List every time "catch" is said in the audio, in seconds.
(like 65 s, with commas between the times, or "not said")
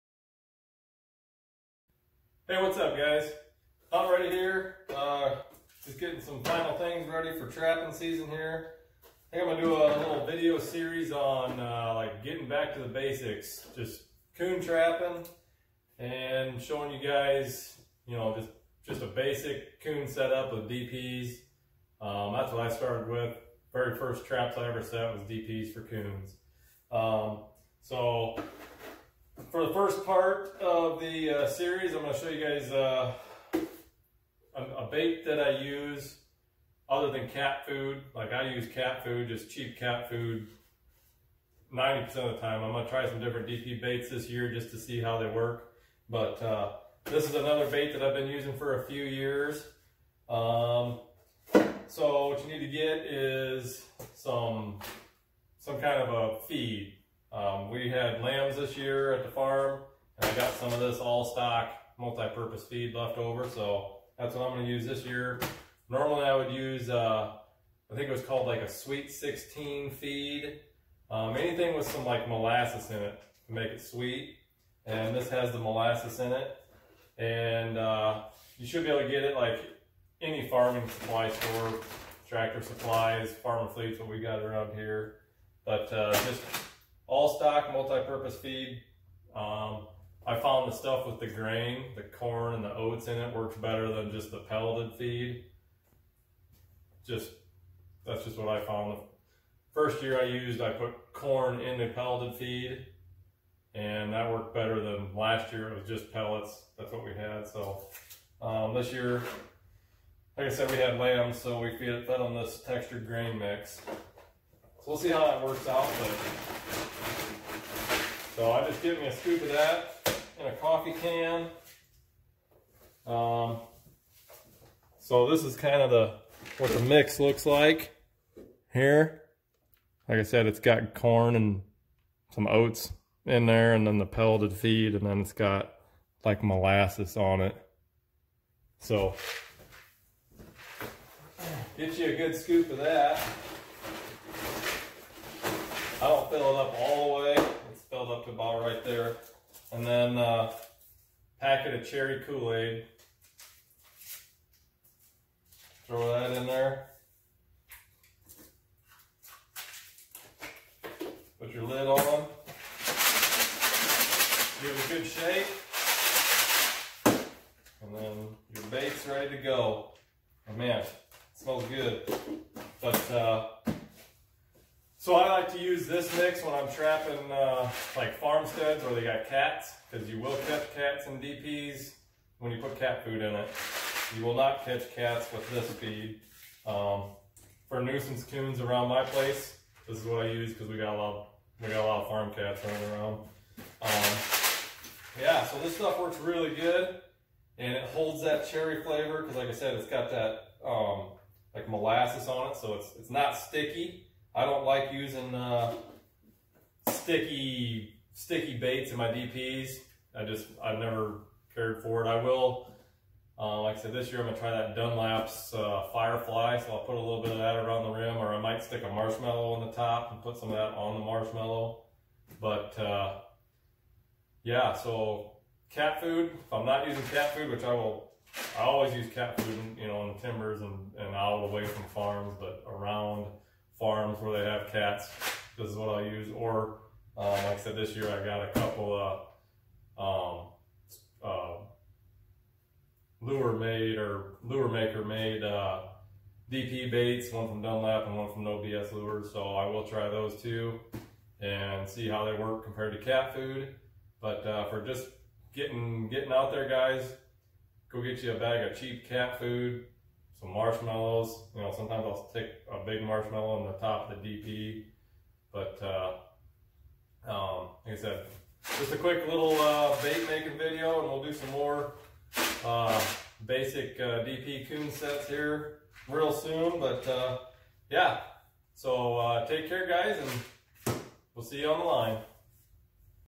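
180 s, 184 s.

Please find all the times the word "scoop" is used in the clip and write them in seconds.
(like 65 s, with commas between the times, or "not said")
119 s, 142 s.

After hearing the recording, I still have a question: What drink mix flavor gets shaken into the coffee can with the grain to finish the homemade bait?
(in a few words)
Cherry Kool-Aid.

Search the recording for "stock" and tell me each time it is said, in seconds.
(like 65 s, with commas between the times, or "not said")
61 s, 87 s.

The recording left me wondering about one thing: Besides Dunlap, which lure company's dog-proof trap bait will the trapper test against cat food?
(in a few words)
No BS Lures.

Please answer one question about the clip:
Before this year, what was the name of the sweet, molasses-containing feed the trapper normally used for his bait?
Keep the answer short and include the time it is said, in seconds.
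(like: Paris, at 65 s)
Sweet 16, at 68 s.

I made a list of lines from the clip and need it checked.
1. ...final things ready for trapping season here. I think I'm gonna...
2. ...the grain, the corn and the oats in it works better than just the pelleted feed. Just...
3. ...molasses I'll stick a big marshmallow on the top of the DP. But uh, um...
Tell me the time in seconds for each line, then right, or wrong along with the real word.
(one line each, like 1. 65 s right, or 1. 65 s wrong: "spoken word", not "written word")
1. 6 s right
2. 91 s right
3. 261 s wrong: "sometimes", not "molasses".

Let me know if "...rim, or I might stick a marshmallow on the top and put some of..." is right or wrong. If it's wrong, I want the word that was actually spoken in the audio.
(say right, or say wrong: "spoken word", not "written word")
right.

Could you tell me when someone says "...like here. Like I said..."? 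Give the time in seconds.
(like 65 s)
127 s.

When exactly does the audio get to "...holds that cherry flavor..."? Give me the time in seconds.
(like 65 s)
197 s.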